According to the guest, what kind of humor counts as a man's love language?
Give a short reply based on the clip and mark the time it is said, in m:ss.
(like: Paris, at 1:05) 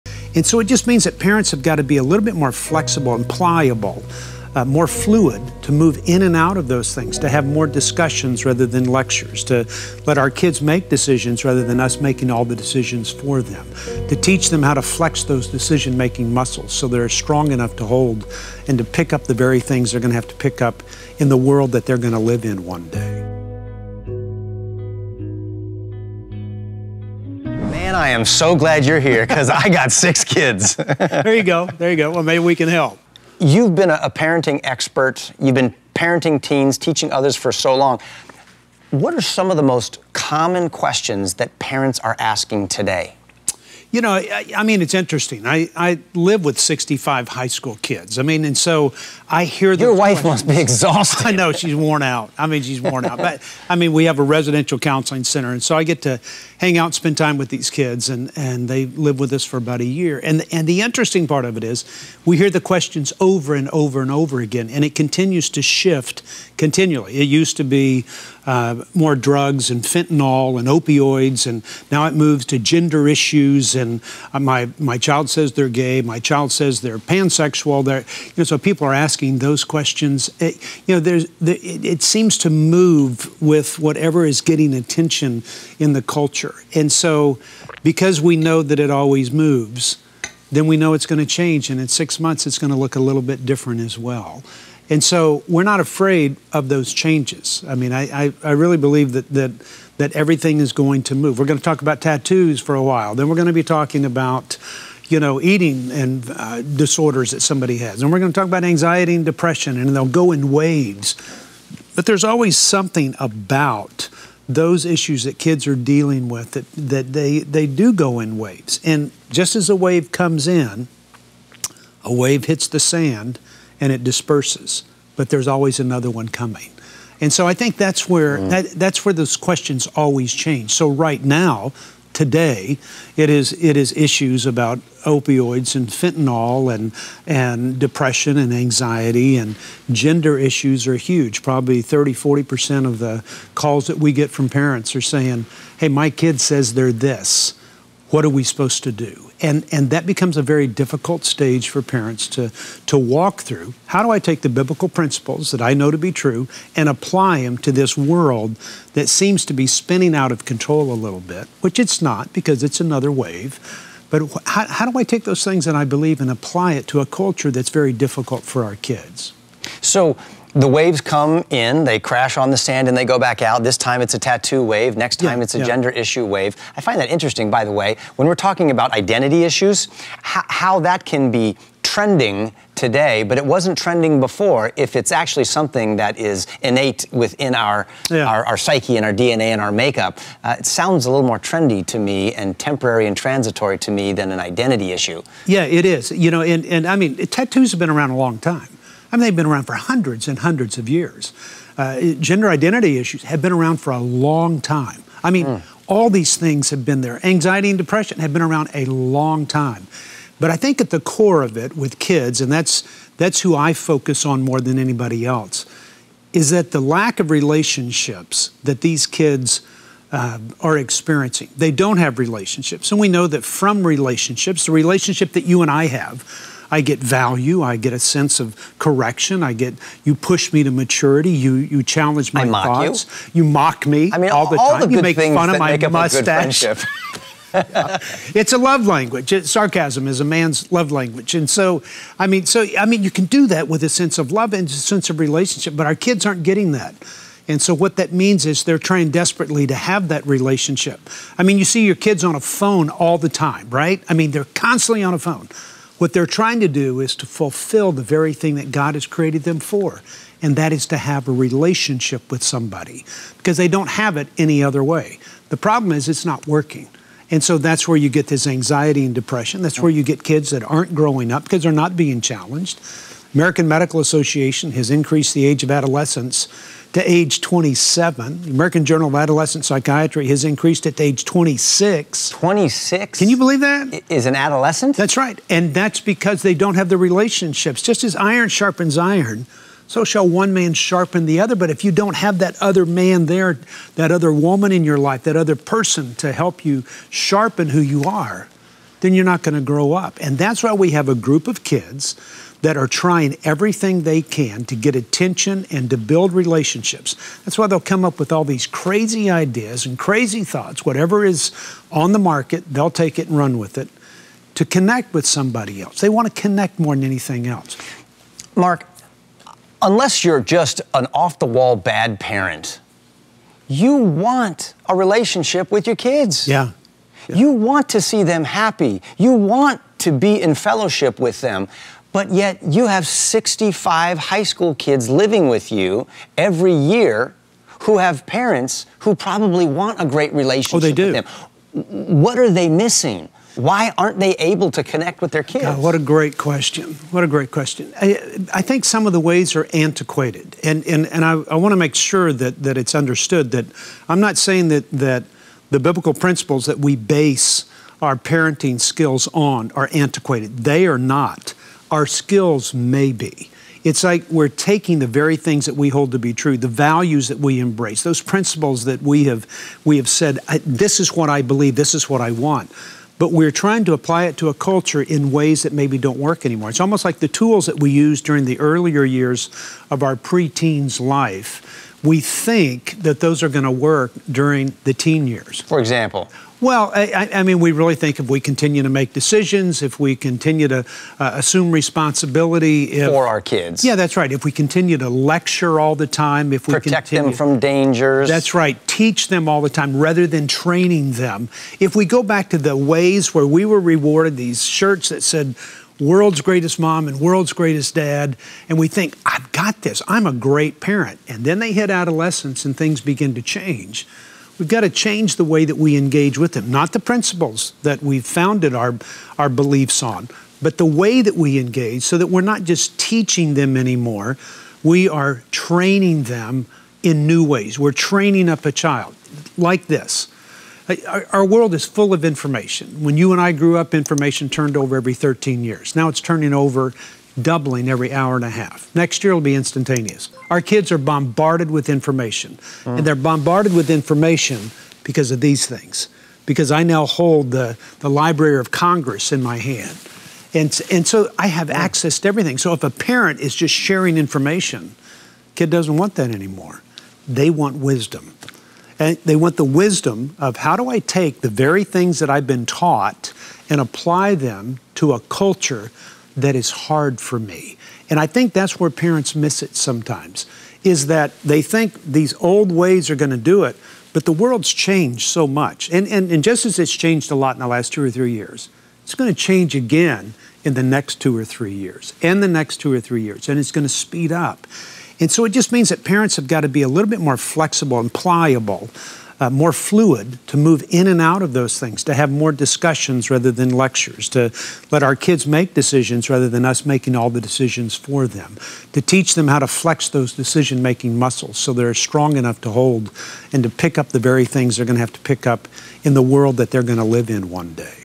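Sarcasm, at 3:59.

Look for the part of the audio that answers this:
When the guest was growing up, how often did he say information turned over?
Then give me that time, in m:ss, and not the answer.
7:15.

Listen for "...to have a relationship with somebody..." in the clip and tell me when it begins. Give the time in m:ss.
4:20.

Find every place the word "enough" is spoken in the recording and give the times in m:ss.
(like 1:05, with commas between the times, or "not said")
0:17, 8:22.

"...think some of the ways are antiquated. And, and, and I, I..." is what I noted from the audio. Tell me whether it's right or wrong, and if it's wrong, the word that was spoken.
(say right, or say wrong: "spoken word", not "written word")
right.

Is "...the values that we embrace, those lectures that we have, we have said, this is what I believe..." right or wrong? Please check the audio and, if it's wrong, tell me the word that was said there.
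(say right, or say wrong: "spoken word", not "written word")
wrong: "principles", not "lectures".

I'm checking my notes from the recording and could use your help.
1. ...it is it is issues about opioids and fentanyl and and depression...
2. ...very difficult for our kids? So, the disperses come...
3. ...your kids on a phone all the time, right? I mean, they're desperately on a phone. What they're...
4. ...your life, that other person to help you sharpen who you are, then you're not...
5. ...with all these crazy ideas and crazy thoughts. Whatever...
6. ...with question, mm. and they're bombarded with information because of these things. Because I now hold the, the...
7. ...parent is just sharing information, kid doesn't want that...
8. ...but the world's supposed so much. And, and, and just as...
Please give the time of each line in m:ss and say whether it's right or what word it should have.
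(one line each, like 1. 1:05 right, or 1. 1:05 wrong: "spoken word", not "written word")
1. 2:13 right
2. 2:47 wrong: "waves", not "disperses"
3. 4:11 wrong: "constantly", not "desperately"
4. 4:54 right
5. 5:08 right
6. 7:21 wrong: "information", not "question"
7. 7:32 right
8. 7:54 wrong: "changed", not "supposed".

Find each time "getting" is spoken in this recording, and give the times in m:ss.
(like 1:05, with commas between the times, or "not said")
1:24, 4:06.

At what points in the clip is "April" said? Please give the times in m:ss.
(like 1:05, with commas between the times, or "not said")
not said.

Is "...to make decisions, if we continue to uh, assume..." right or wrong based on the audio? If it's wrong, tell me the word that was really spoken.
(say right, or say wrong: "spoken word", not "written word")
right.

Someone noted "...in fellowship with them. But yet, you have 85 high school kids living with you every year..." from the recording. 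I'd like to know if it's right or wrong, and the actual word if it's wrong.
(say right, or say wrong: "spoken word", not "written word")
wrong: "65", not "85".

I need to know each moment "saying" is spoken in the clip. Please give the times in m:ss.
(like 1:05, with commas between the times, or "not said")
2:25, 5:54.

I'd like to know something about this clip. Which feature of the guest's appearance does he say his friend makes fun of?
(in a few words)
Mustache.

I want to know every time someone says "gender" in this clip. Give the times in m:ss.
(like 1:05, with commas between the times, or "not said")
1:12, 2:19, 2:55, 3:22.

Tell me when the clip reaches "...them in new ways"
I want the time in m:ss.
7:06.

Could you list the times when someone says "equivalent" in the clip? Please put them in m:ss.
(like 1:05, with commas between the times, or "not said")
not said.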